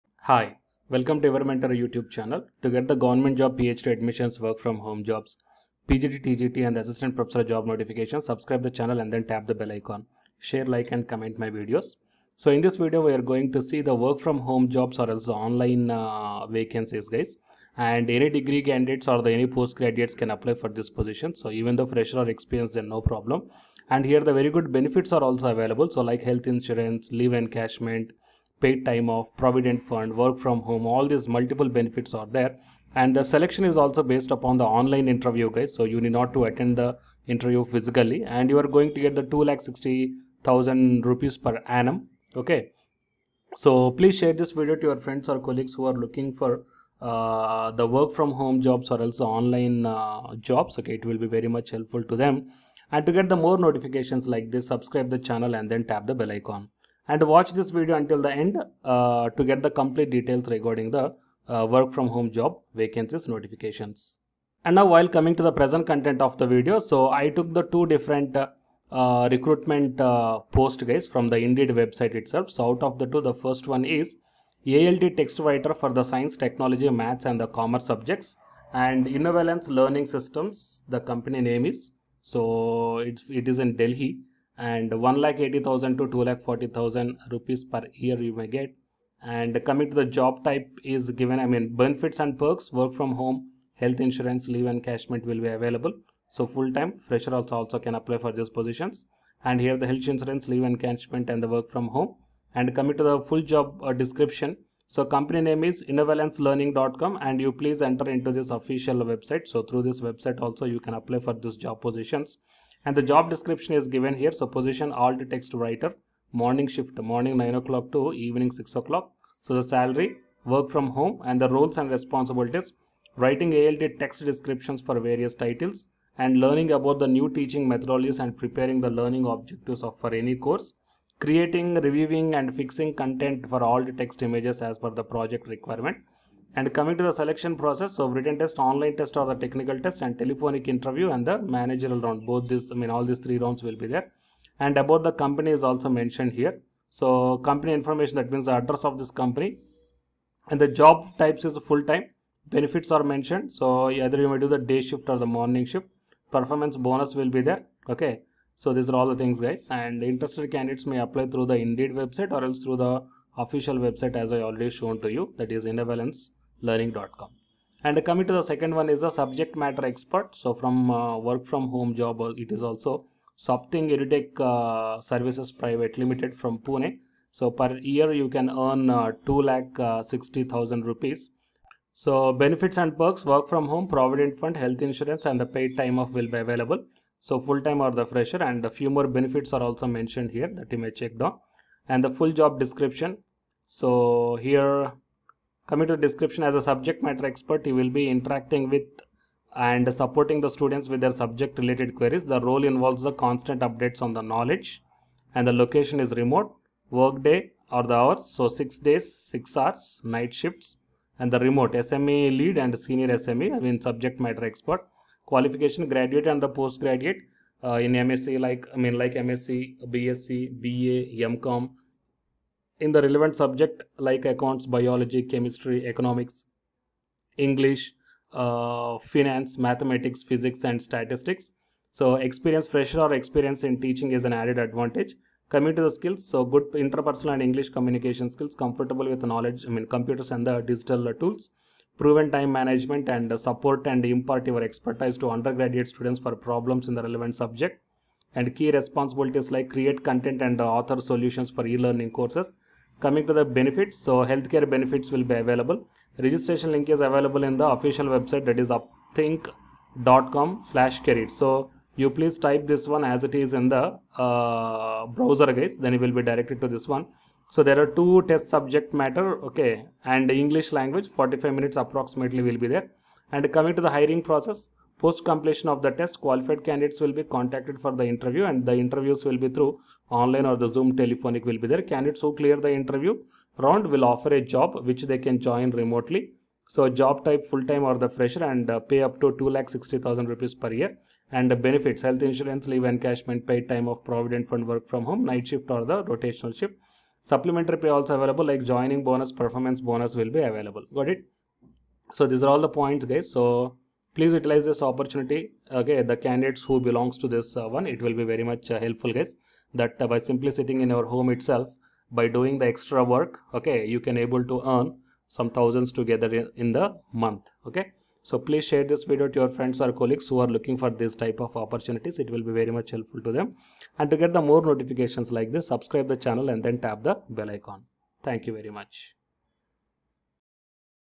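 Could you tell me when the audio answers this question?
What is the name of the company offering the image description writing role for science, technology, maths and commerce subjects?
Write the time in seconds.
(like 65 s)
79 s.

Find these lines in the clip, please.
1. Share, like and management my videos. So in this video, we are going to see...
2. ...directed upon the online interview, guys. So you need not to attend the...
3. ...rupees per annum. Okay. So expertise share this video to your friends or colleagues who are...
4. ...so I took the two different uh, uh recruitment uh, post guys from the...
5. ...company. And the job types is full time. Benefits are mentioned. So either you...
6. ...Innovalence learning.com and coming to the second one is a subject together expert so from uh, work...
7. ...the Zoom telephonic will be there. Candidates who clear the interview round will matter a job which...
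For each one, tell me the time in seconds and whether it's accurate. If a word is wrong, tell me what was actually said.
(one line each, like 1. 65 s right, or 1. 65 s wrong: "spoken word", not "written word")
1. 10 s wrong: "comment", not "management"
2. 34 s wrong: "based", not "directed"
3. 41 s wrong: "please", not "expertise"
4. 66 s right
5. 149 s right
6. 165 s wrong: "matter", not "together"
7. 280 s wrong: "offer", not "matter".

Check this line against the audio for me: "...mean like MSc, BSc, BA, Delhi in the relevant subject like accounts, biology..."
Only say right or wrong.
wrong.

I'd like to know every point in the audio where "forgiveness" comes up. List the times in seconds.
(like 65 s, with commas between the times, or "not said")
not said.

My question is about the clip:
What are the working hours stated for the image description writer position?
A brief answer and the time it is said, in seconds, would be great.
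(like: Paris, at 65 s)
9 am to 6 pm, at 117 s.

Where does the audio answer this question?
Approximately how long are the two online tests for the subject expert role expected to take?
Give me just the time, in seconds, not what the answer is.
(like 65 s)
271 s.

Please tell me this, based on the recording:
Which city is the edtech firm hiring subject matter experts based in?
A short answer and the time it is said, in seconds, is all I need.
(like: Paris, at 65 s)
Pune, at 176 s.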